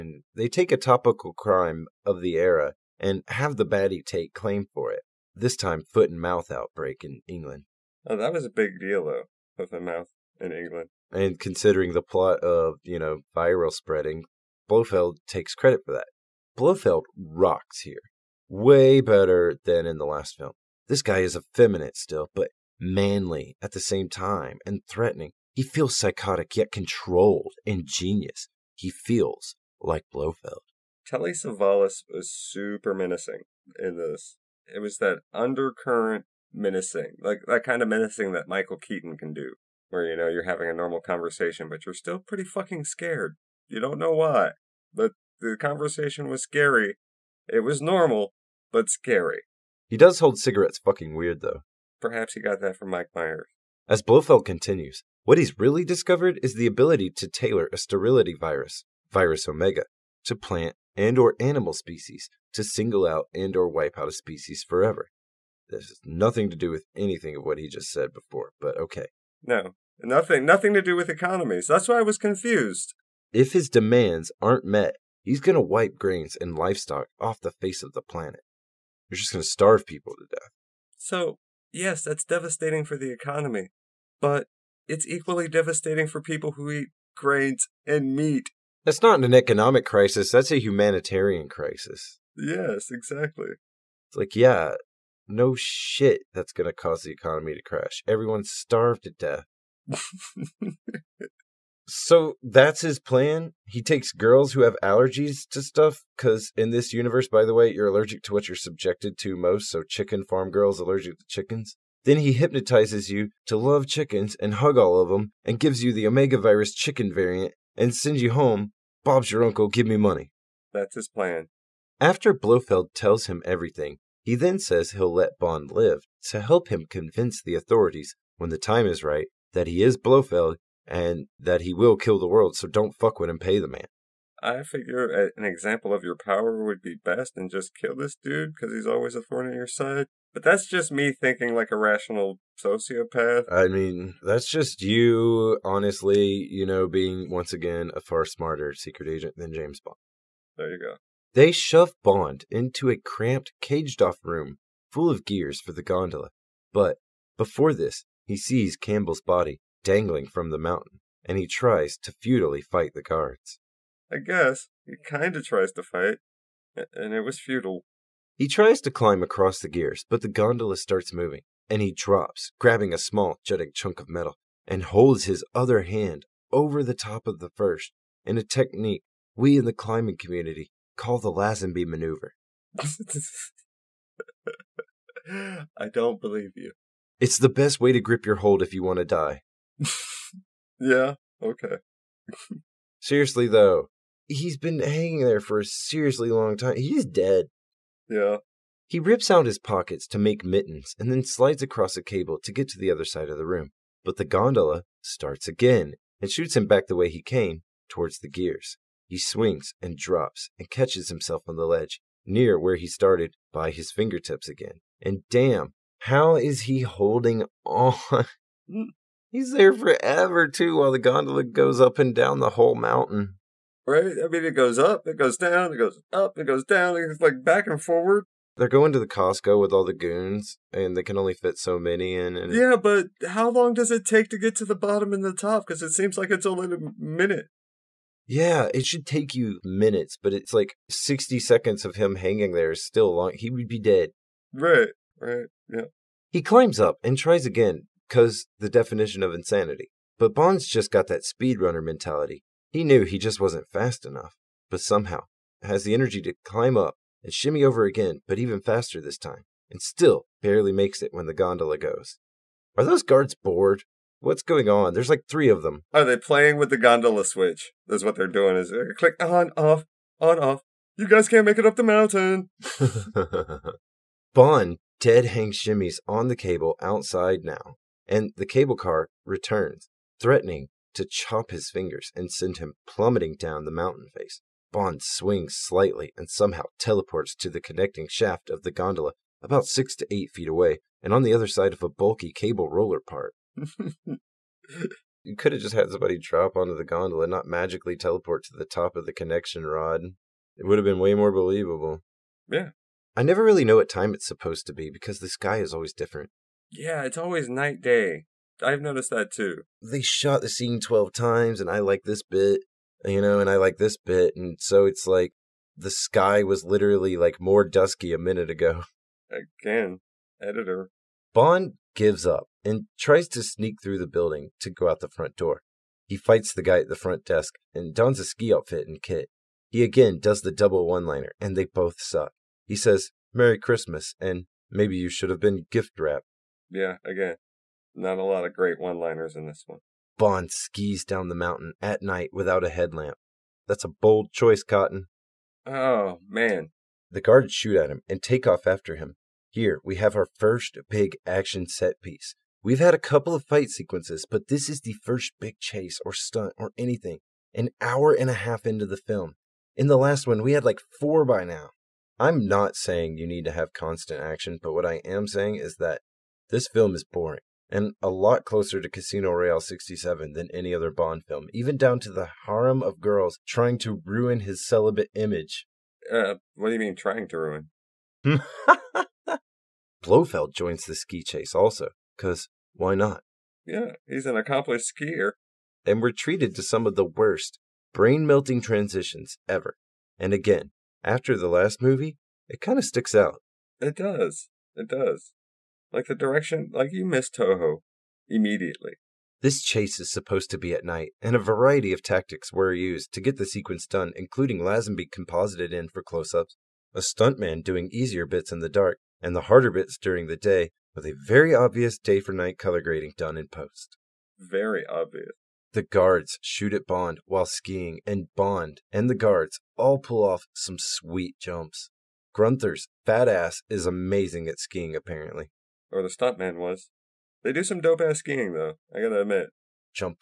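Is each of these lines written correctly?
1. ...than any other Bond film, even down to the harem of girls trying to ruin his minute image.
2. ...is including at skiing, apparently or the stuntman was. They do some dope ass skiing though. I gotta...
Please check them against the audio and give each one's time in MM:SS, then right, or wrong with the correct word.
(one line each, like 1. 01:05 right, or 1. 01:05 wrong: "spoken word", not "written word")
1. 06:10 wrong: "celibate", not "minute"
2. 07:03 wrong: "amazing", not "including".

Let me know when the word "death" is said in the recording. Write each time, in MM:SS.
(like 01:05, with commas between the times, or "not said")
01:20, 01:39.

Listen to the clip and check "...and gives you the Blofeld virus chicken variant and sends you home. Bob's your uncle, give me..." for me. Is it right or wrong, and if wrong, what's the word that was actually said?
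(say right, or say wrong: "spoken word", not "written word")
wrong: "Omega", not "Blofeld".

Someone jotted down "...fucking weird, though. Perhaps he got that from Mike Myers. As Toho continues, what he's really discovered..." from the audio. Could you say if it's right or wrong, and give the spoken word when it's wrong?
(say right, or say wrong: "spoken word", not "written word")
wrong: "Blofeld", not "Toho".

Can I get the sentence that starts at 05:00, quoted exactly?
It would have been way more believable.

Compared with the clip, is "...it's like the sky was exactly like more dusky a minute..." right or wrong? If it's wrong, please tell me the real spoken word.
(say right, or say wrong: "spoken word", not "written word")
wrong: "literally", not "exactly".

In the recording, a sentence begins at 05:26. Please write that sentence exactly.
He fights the guy at the front desk and dons a ski outfit and kit.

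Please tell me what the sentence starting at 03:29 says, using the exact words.
He swings and drops and catches himself on the ledge, near where he started, by his fingertips again.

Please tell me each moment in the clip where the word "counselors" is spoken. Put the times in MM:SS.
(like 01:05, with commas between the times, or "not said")
not said.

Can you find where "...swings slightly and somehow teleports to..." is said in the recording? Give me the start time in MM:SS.
04:45.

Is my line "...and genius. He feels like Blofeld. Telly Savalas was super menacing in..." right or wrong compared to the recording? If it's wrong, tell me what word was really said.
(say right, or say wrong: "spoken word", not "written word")
right.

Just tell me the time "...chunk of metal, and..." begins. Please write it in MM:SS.
02:53.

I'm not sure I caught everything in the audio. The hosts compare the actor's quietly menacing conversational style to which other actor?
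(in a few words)
Michael Keaton.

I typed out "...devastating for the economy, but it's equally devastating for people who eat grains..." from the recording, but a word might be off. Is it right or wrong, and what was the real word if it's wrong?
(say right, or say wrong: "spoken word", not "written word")
right.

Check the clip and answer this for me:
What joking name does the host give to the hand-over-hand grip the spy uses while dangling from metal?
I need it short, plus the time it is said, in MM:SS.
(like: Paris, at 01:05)
The Lazenby maneuver, at 03:01.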